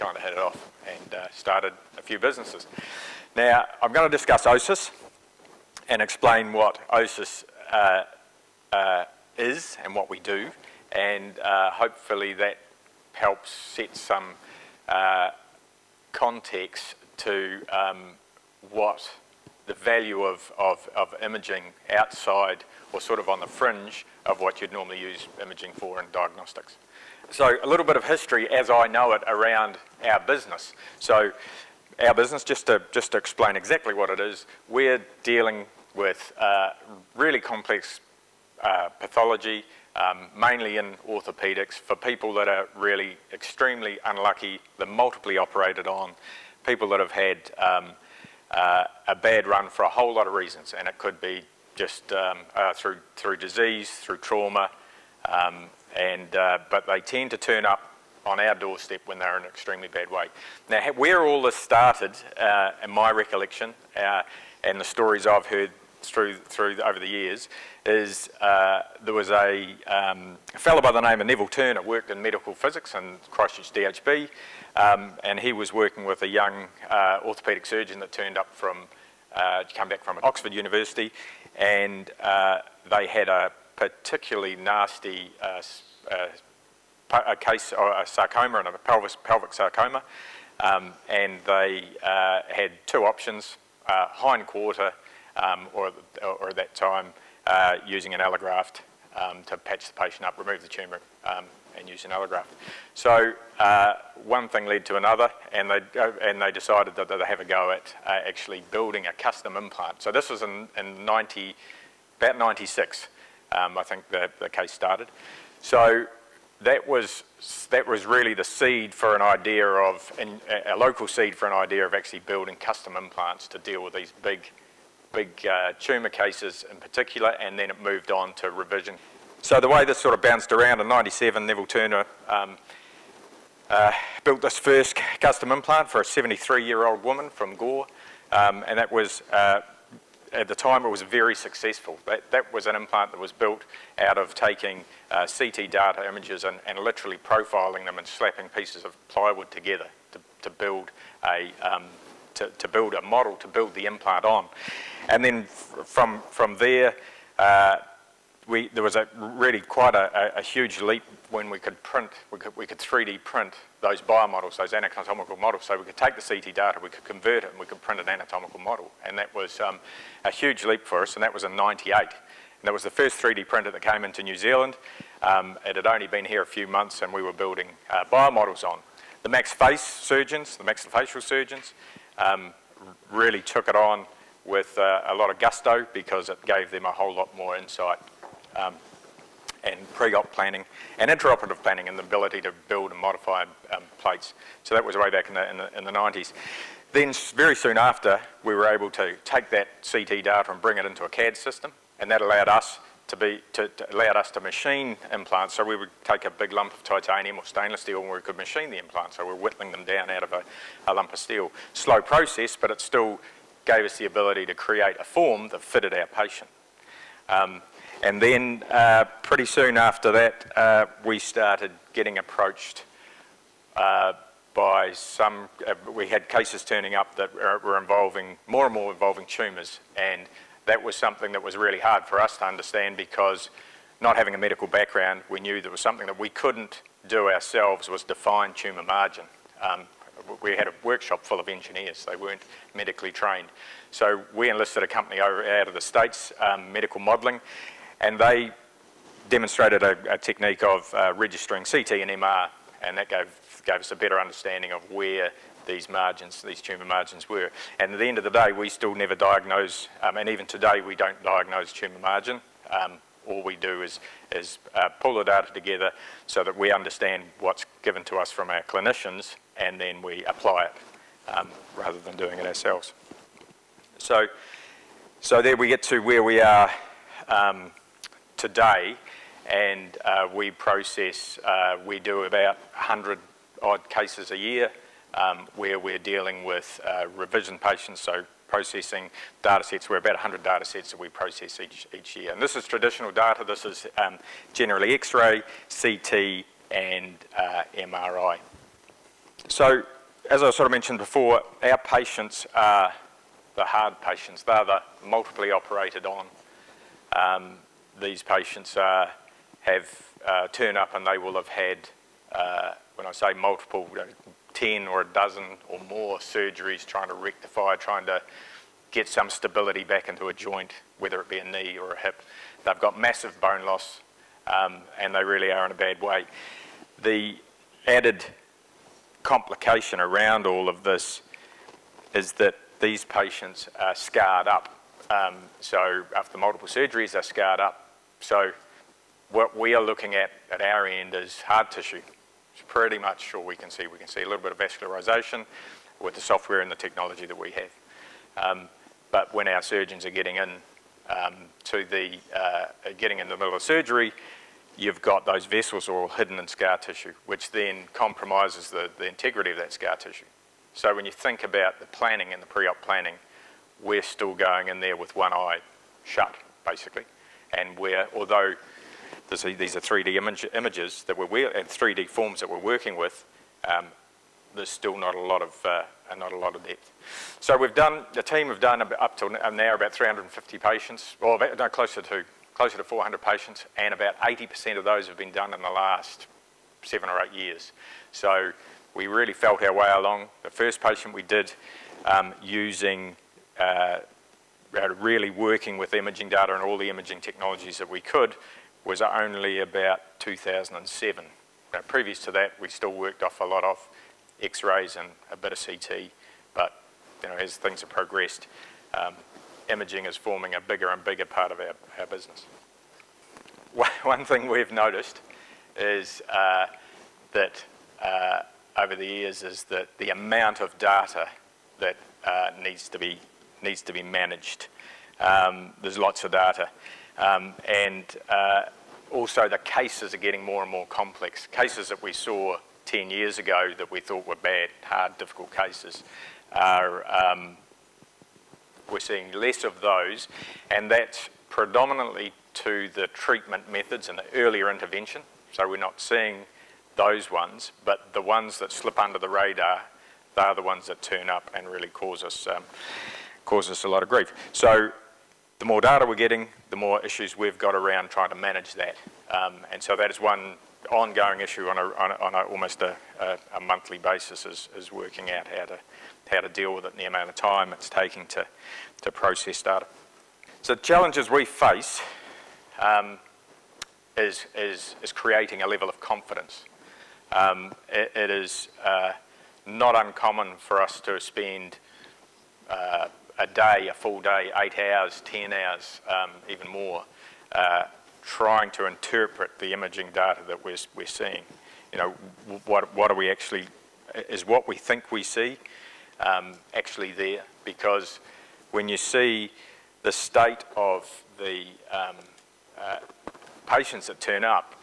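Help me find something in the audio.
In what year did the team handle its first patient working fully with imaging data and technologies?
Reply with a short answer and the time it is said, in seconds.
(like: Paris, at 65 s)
2007, at 400 s.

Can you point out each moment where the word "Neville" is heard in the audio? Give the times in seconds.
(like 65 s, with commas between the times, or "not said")
71 s, 131 s.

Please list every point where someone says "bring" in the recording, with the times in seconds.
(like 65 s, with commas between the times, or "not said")
200 s.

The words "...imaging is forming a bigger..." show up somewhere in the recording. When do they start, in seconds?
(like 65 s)
409 s.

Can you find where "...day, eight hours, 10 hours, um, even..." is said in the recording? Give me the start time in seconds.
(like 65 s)
484 s.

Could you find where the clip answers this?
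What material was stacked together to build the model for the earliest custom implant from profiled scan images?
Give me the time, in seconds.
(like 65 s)
149 s.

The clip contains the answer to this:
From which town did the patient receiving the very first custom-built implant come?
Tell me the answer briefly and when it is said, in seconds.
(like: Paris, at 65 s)
Gore, at 137 s.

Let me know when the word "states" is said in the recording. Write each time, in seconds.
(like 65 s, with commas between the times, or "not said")
245 s, 500 s.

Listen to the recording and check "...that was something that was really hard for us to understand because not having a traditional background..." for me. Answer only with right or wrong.
wrong.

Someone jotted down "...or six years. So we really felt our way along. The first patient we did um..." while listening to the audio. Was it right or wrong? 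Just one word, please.
wrong.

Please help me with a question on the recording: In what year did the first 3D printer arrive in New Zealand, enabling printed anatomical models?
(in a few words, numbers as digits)
1998.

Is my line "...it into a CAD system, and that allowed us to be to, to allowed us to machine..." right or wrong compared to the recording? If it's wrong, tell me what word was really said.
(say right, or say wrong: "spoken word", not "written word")
right.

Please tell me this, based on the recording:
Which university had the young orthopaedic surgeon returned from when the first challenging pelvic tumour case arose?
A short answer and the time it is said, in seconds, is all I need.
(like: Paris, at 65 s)
Oxford University, at 80 s.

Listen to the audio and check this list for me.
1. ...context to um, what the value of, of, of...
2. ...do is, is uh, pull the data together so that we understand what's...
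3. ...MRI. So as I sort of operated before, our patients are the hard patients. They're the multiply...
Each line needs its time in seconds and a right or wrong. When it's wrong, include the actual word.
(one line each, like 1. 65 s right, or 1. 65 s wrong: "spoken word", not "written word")
1. 16 s right
2. 263 s right
3. 297 s wrong: "mentioned", not "operated".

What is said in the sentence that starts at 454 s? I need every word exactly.
So the more data we're getting, the more issues we've got around trying to manage that.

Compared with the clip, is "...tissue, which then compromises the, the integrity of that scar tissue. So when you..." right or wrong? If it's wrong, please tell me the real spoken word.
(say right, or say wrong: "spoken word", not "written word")
right.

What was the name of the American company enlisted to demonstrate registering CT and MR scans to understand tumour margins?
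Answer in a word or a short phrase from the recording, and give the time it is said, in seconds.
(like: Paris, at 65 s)
Medical Modelling, at 246 s.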